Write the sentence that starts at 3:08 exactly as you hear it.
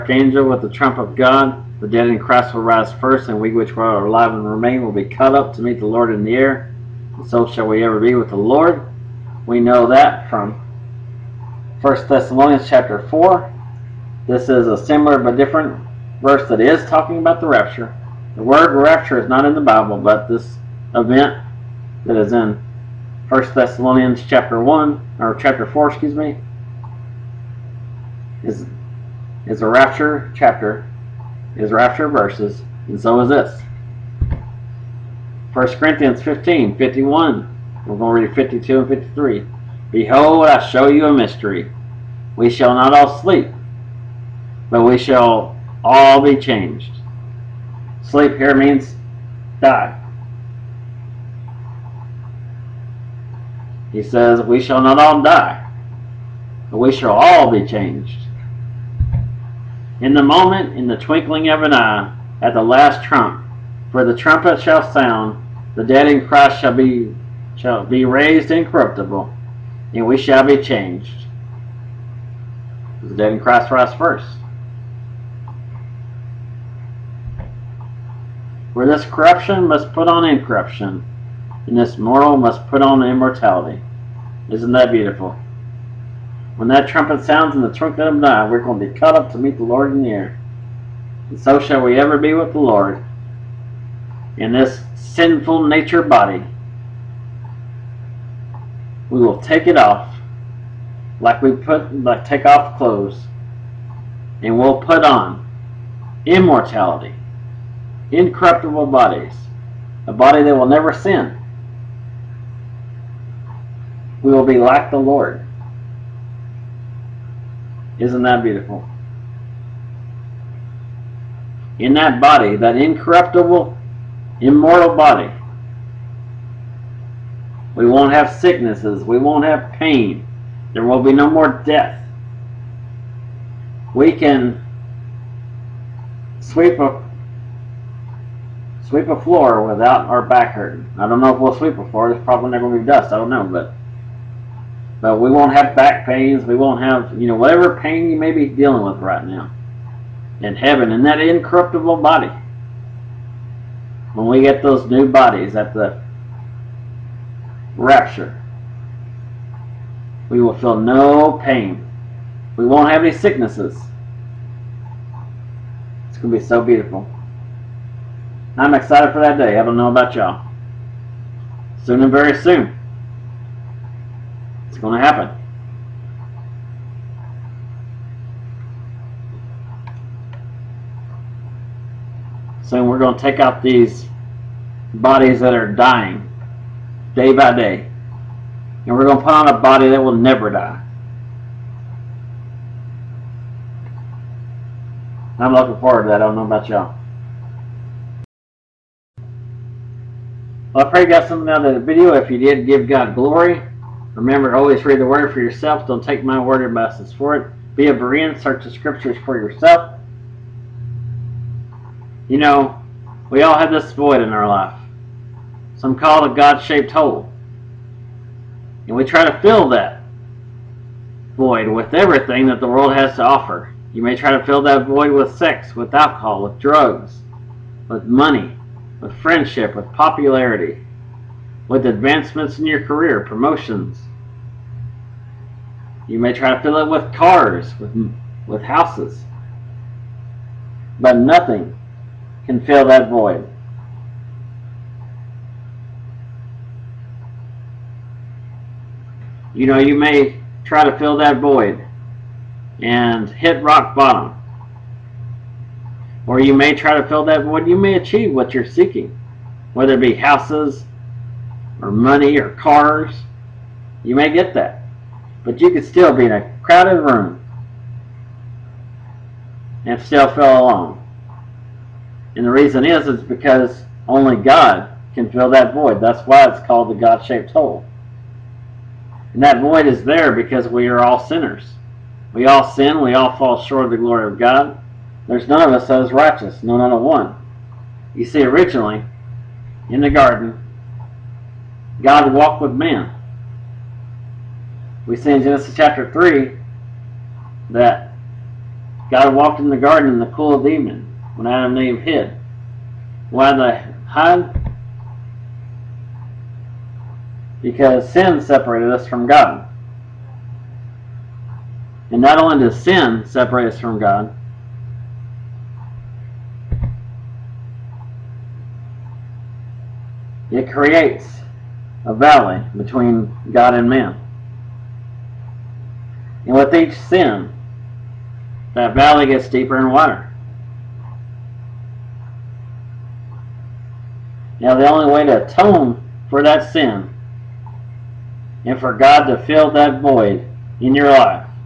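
And we're going to put on a body that will never die.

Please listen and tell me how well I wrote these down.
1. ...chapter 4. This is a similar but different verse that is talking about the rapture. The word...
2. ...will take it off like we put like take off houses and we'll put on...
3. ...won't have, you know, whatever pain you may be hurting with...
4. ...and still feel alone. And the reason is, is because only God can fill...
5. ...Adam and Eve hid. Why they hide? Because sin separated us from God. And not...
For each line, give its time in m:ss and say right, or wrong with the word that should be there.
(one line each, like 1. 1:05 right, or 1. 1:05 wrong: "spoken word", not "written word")
1. 0:12 right
2. 1:39 wrong: "clothes", not "houses"
3. 2:26 wrong: "dealing", not "hurting"
4. 4:29 right
5. 5:01 right.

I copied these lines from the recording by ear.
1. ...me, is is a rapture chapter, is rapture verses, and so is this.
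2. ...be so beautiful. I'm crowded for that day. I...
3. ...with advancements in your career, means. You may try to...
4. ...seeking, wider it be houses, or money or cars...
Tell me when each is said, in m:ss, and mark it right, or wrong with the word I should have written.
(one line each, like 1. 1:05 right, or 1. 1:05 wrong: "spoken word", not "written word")
1. 0:26 right
2. 2:46 wrong: "excited", not "crowded"
3. 3:51 wrong: "promotions", not "means"
4. 4:18 wrong: "whether", not "wider".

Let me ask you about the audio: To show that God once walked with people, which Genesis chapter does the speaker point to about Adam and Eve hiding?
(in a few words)
Genesis chapter 3.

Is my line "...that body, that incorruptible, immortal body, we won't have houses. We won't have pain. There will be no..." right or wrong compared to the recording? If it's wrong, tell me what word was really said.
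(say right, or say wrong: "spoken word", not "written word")
wrong: "sicknesses", not "houses".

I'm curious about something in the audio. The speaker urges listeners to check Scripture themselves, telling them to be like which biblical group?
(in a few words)
A Berean.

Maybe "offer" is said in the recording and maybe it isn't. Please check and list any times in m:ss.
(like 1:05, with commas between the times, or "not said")
3:43.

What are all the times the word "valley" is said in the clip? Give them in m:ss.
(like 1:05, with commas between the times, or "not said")
5:22, 5:28.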